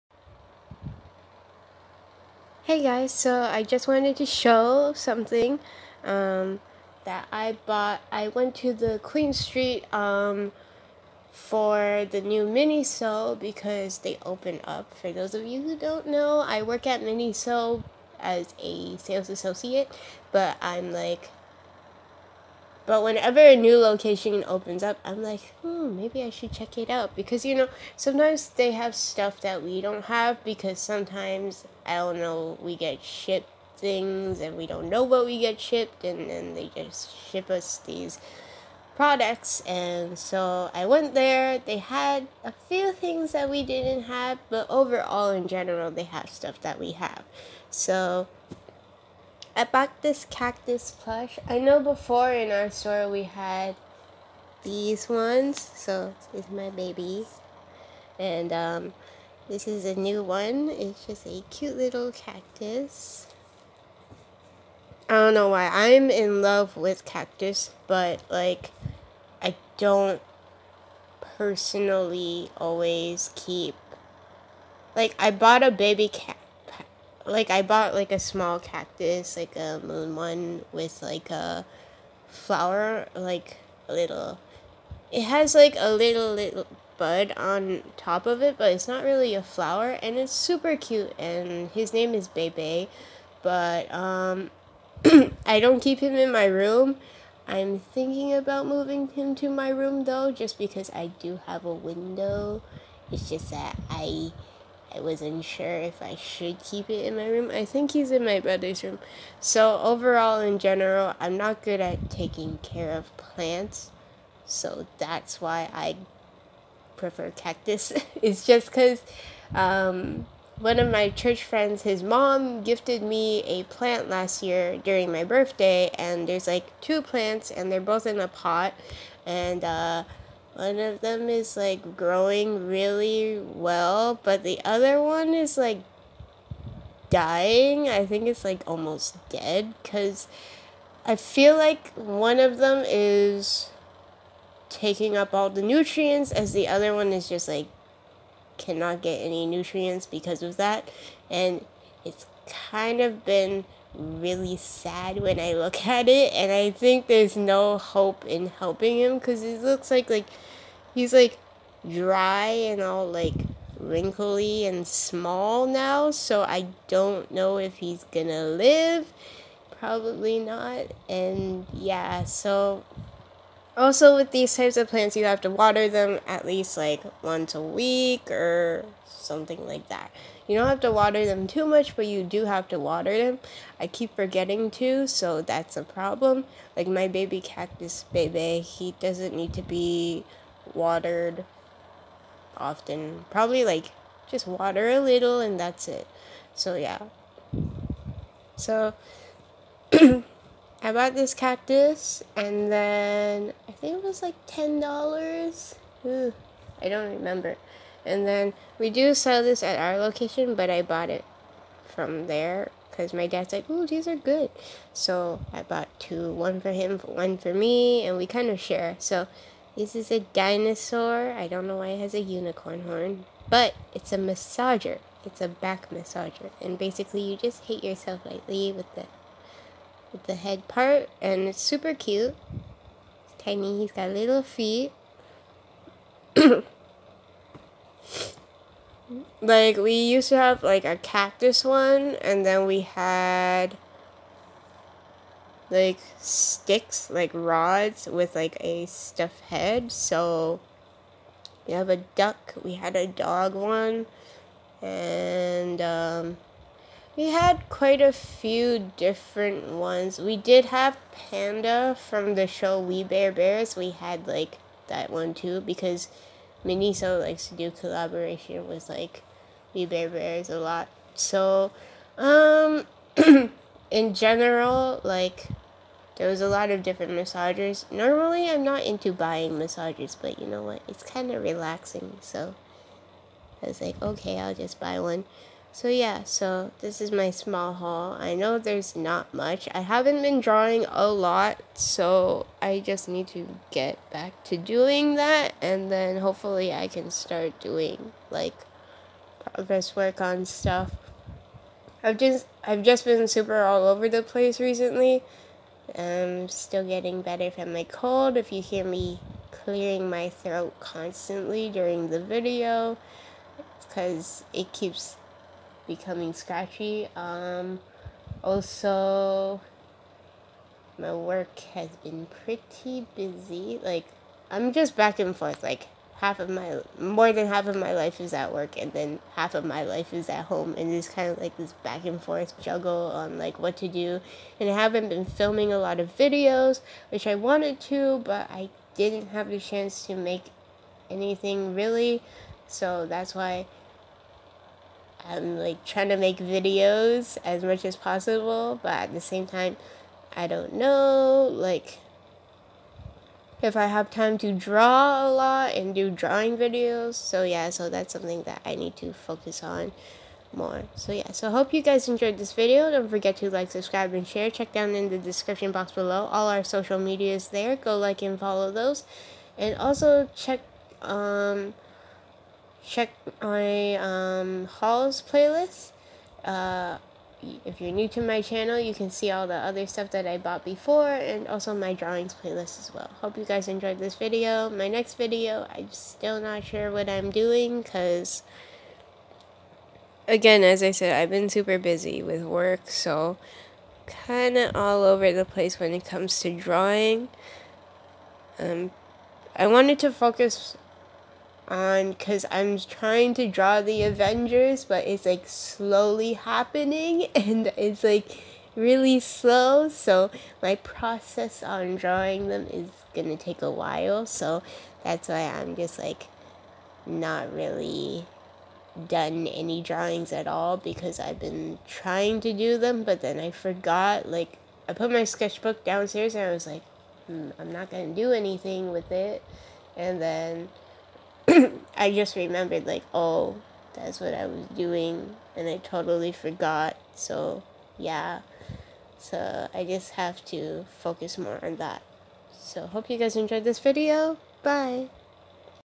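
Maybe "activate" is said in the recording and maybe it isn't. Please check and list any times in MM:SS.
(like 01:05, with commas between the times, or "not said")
not said.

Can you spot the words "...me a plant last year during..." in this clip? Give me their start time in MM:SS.
02:03.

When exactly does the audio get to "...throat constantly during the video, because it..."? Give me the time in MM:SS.
05:10.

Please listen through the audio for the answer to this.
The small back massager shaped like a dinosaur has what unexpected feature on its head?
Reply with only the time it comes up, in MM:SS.
03:42.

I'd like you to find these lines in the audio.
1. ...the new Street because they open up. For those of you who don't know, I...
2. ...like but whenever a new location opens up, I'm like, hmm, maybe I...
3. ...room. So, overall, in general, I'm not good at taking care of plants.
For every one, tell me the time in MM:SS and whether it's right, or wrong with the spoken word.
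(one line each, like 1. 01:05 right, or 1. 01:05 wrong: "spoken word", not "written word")
1. 00:12 wrong: "Miniso", not "Street"
2. 00:20 right
3. 01:48 right.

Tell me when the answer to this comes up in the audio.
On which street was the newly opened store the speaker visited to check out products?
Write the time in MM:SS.
00:08.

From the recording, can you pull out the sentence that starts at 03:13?
Probably like just water a little and that's it.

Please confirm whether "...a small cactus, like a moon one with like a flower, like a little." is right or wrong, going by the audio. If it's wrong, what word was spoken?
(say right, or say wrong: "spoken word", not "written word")
right.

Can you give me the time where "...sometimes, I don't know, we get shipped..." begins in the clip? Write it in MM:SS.
00:30.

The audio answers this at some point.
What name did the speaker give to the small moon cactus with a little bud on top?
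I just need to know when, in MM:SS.
01:32.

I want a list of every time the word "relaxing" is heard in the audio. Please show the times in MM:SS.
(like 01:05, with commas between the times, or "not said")
04:41.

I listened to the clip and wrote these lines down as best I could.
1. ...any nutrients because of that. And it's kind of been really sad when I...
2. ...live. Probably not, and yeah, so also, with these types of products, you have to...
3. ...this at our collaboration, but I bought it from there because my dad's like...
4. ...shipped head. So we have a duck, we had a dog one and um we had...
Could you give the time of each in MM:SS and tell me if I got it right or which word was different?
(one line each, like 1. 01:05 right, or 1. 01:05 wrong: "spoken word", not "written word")
1. 02:29 right
2. 02:48 wrong: "plants", not "products"
3. 03:29 wrong: "location", not "collaboration"
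4. 04:08 wrong: "stuffed", not "shipped".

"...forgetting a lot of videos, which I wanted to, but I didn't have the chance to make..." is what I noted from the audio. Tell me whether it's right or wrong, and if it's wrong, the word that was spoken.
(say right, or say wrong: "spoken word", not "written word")
wrong: "filming", not "forgetting".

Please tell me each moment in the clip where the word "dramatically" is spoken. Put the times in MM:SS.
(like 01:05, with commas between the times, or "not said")
not said.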